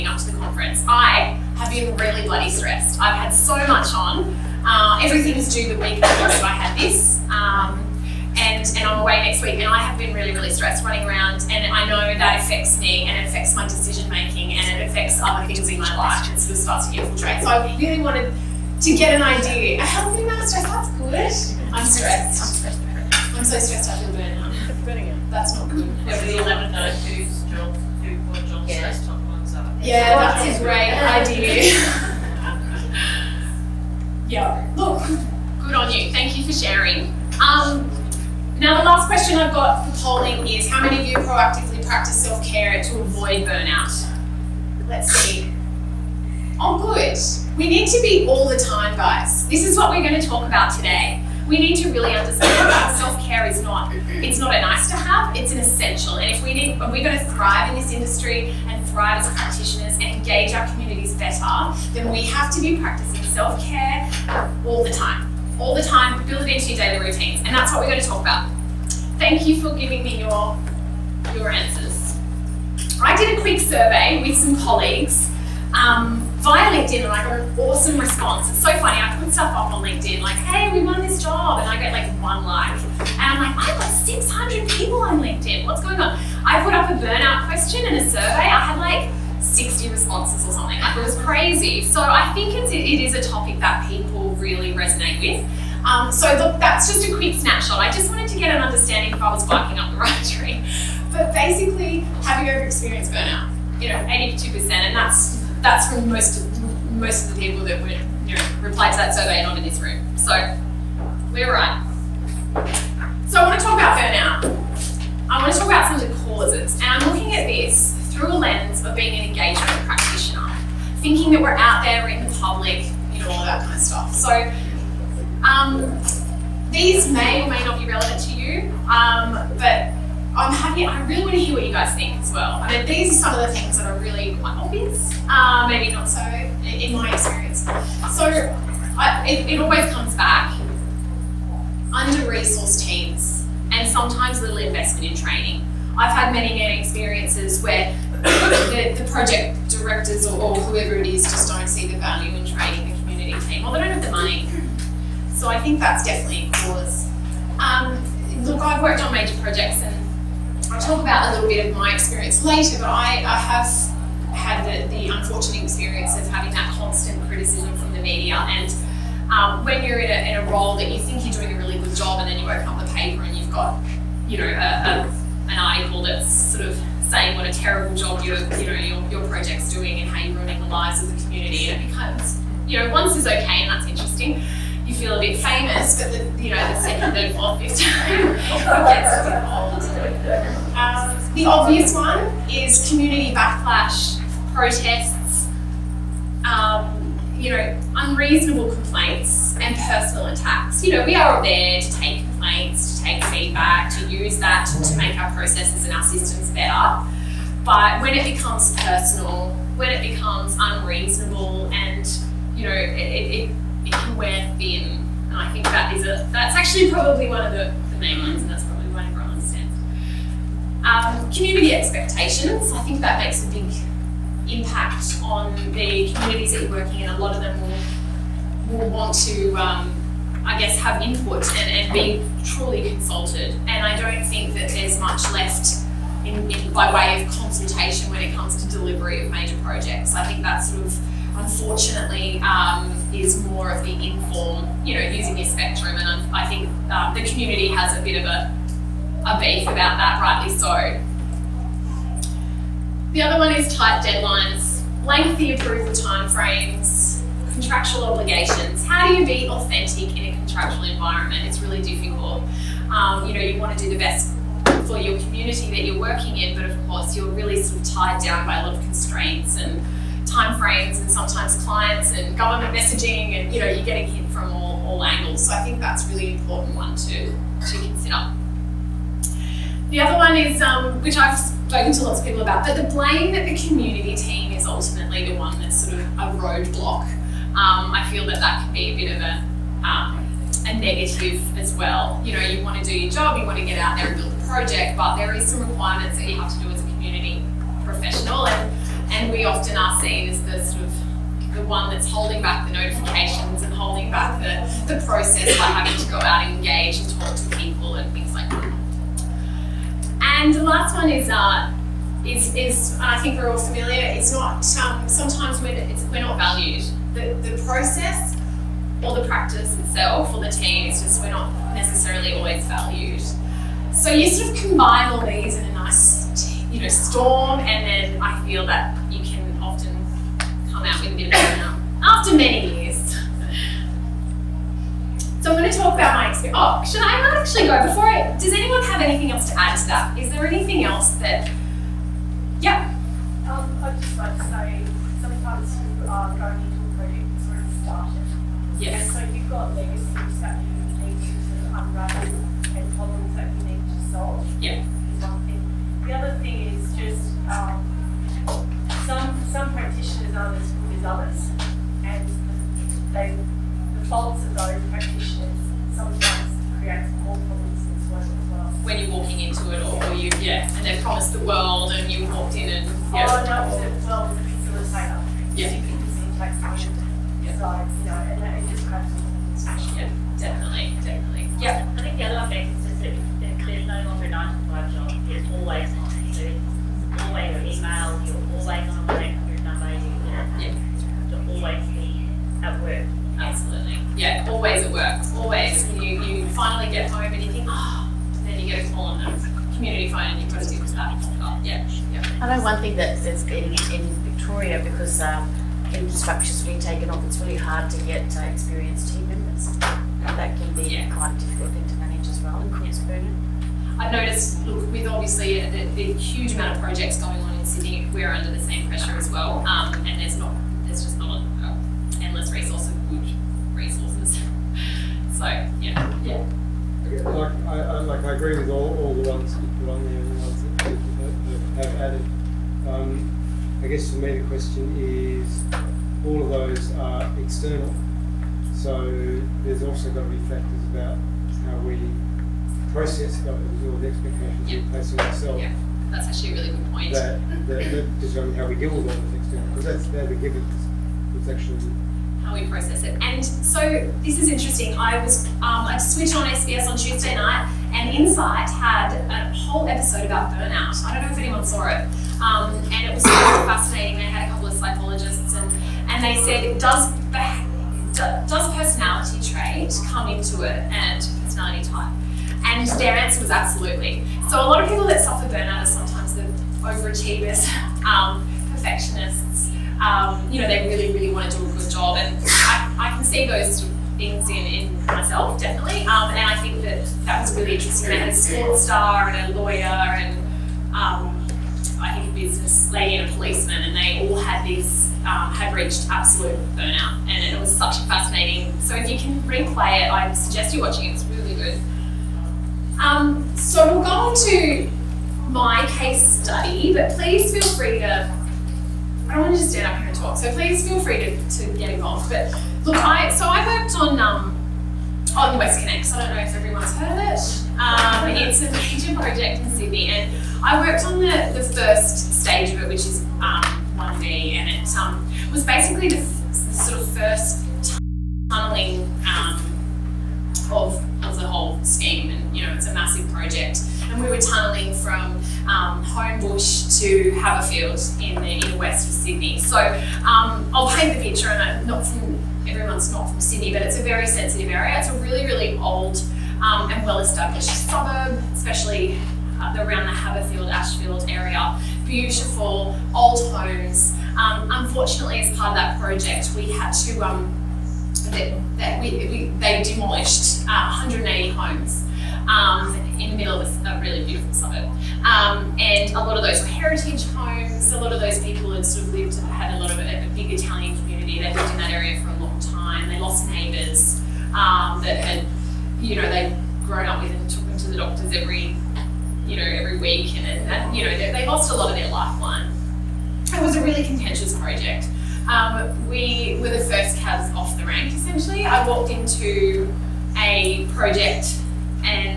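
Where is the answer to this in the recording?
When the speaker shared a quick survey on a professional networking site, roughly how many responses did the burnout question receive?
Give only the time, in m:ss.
1:29.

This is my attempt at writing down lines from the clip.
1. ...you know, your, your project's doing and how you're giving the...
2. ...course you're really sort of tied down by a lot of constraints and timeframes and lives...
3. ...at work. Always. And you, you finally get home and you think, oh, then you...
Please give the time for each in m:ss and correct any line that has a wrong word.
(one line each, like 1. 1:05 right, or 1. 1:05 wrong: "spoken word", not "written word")
1. 2:58 wrong: "ruining", not "giving"
2. 4:26 wrong: "sometimes", not "lives"
3. 6:34 right.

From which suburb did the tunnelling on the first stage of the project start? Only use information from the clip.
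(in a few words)
Homebush.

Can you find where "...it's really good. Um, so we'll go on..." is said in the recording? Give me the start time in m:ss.
8:21.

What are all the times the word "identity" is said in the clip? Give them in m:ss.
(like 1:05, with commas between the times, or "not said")
not said.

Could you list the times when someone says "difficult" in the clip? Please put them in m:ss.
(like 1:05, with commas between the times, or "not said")
4:21, 6:51.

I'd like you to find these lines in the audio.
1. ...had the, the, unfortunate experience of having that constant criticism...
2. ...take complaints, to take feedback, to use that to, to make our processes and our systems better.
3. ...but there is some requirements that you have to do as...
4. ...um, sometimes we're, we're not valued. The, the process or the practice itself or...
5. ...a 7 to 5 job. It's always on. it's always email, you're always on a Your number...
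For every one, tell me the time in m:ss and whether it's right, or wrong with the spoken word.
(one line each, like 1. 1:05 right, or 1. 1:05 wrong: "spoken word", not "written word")
1. 2:44 right
2. 3:21 right
3. 4:54 right
4. 5:14 right
5. 6:24 wrong: "9", not "7".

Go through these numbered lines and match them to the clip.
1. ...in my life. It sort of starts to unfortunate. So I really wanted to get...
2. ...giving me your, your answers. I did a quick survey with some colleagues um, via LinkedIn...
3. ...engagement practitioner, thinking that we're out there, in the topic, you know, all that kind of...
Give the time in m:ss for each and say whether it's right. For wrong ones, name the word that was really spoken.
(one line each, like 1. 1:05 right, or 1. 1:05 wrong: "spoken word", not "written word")
1. 0:15 wrong: "infiltrate", not "unfortunate"
2. 1:09 right
3. 1:59 wrong: "public", not "topic".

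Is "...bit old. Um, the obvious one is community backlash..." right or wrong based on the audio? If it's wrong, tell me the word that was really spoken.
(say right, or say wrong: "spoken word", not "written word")
right.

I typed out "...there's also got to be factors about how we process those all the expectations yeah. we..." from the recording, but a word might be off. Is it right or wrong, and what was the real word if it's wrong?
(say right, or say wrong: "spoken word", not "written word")
right.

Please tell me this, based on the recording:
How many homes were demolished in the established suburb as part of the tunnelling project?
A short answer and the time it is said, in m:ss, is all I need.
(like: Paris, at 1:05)
180, at 9:21.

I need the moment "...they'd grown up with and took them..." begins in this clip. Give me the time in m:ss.
9:36.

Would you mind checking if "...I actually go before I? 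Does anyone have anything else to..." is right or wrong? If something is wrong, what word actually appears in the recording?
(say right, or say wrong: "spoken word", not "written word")
right.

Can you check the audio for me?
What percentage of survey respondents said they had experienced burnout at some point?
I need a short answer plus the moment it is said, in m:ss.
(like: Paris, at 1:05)
82%, at 1:43.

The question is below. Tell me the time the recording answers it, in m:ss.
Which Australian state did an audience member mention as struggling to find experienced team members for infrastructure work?
6:44.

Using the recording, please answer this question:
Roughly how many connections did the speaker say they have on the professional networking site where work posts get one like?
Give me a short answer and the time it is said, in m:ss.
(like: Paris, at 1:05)
600, at 1:23.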